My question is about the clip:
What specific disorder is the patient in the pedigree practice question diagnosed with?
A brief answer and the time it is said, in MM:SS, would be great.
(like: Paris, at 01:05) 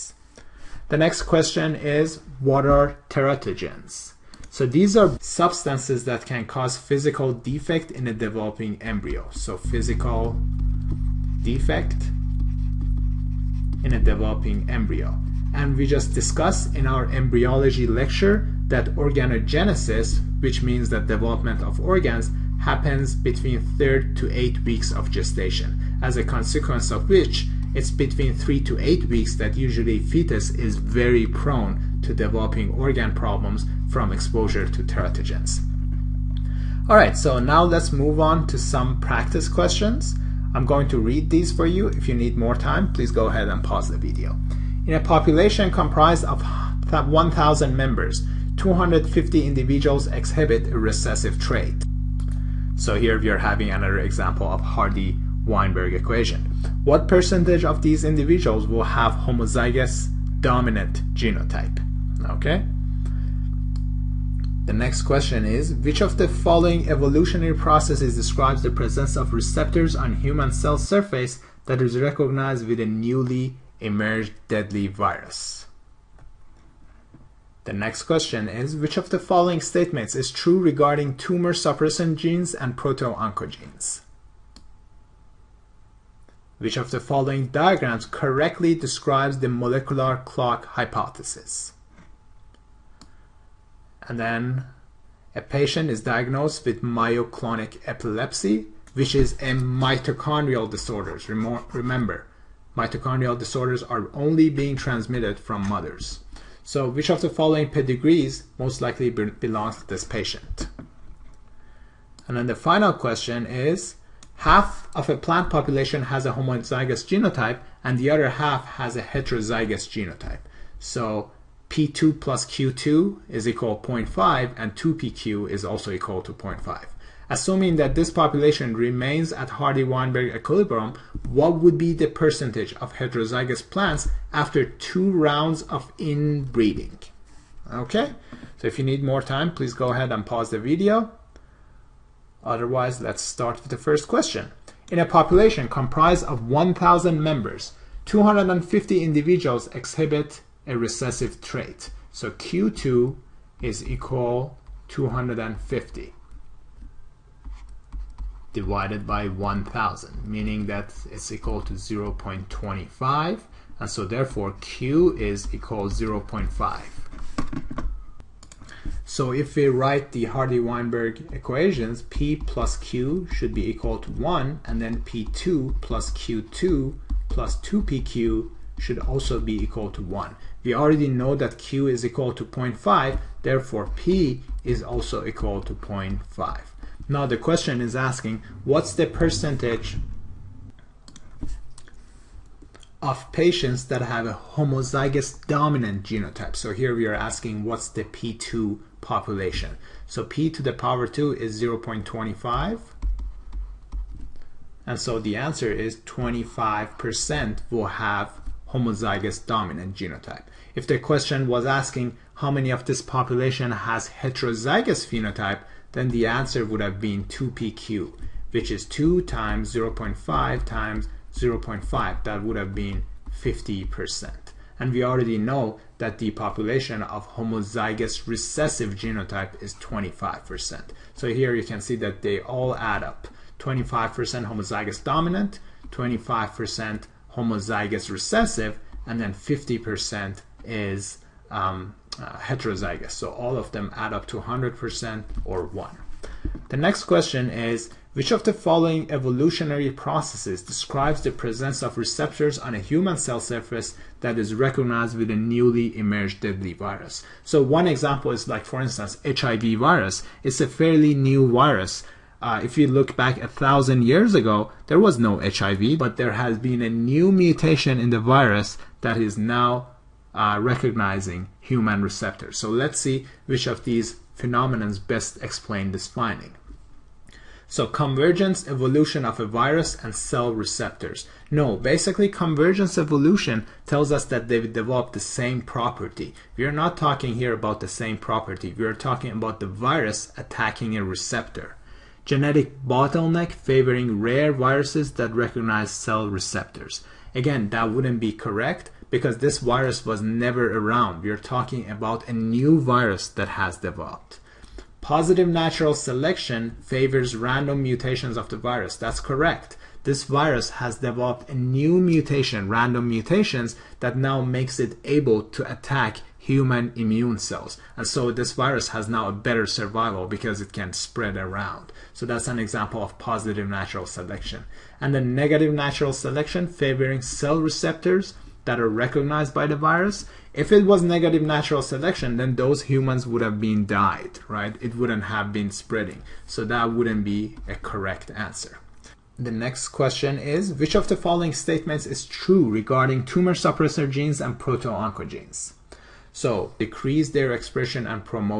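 myoclonic epilepsy, at 01:36.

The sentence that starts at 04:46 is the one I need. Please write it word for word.
We are not talking here about the same property.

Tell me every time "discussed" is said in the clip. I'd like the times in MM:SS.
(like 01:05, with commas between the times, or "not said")
00:16.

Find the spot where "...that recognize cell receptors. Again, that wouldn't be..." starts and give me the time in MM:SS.
04:55.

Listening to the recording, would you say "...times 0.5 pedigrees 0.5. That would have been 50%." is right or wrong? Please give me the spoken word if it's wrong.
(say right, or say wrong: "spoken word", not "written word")
wrong: "times", not "pedigrees".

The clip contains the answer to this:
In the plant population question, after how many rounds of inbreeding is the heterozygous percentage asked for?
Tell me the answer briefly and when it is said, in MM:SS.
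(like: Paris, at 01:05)
2, at 02:14.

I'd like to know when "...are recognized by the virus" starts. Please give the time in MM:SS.
05:28.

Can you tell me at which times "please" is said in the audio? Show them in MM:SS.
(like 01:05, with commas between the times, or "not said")
00:42, 02:19.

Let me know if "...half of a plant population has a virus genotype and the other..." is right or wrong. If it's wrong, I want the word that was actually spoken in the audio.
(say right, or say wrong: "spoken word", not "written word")
wrong: "homozygous", not "virus".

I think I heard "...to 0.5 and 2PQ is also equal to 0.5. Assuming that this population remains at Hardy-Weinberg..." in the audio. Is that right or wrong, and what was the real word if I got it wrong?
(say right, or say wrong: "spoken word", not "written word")
right.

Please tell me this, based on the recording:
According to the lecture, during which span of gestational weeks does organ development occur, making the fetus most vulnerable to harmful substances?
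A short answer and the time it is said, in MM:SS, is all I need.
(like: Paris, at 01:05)
3rd to 8 weeks, at 00:23.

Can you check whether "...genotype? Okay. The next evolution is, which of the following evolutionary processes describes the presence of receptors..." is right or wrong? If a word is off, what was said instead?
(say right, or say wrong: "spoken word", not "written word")
wrong: "question", not "evolution".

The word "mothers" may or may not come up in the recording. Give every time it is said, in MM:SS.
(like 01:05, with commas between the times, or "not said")
01:45.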